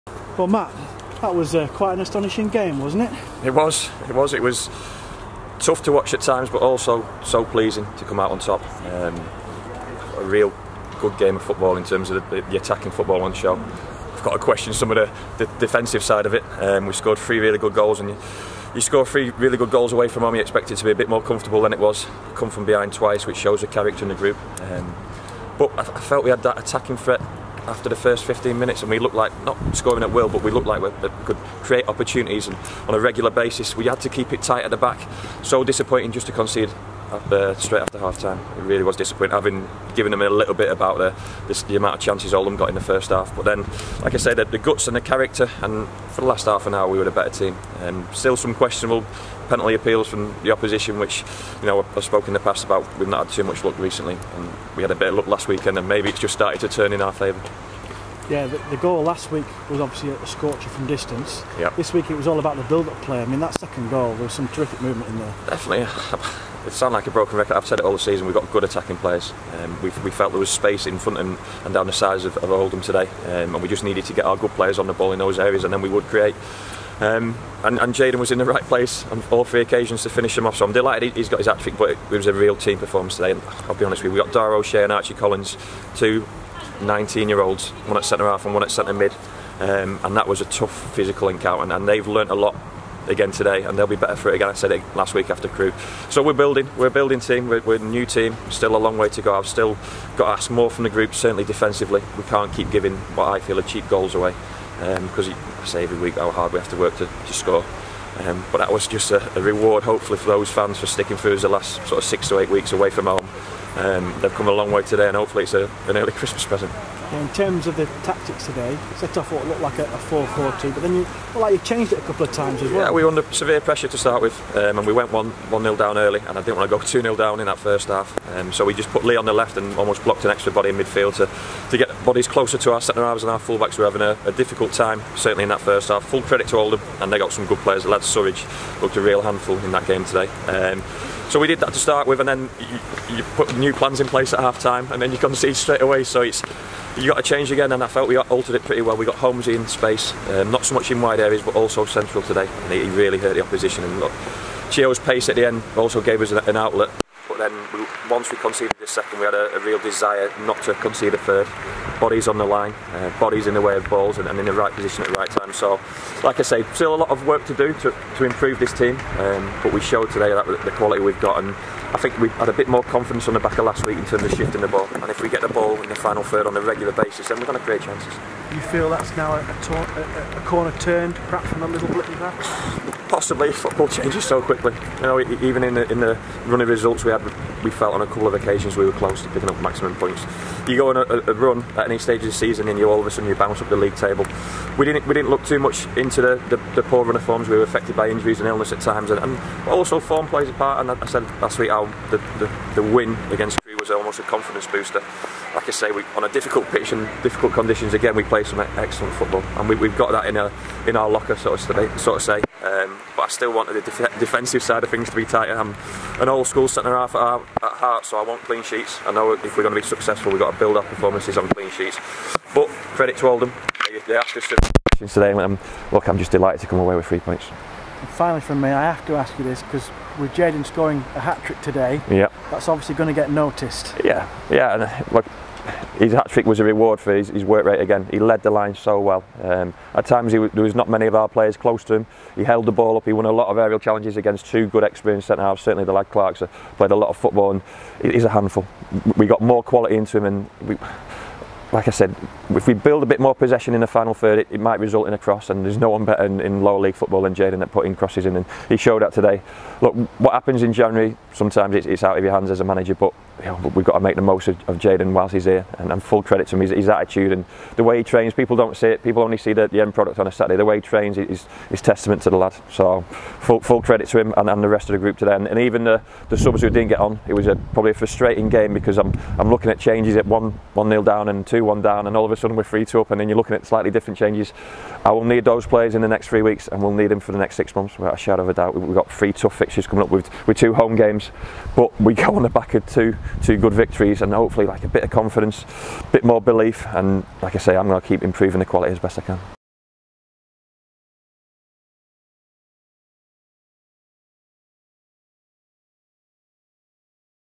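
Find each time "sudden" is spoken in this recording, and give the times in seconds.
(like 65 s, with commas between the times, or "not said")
193 s, 282 s.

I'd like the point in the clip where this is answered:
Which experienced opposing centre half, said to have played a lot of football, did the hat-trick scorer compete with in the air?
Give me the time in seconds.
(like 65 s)
246 s.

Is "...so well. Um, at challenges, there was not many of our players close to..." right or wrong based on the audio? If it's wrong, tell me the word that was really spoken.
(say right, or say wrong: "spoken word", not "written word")
wrong: "times", not "challenges".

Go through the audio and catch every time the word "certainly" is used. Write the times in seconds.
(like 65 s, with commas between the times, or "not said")
101 s, 135 s, 245 s.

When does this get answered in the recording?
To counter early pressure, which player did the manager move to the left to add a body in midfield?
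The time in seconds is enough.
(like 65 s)
129 s.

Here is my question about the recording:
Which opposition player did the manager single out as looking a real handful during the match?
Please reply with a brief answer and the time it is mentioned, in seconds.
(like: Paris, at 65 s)
Surridge, at 137 s.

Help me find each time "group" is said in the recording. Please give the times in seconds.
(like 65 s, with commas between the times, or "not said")
24 s, 100 s, 274 s.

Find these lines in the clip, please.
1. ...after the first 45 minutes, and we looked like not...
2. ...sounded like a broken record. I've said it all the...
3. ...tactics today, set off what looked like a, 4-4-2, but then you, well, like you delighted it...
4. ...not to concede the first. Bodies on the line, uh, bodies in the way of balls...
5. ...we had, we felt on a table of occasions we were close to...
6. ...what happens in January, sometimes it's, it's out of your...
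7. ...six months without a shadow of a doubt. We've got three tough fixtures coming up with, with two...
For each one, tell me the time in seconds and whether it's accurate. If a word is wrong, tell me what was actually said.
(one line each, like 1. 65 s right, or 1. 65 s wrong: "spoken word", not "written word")
1. 27 s wrong: "15", not "45"
2. 66 s right
3. 118 s wrong: "changed", not "delighted"
4. 160 s right
5. 187 s wrong: "couple", not "table"
6. 260 s right
7. 287 s right.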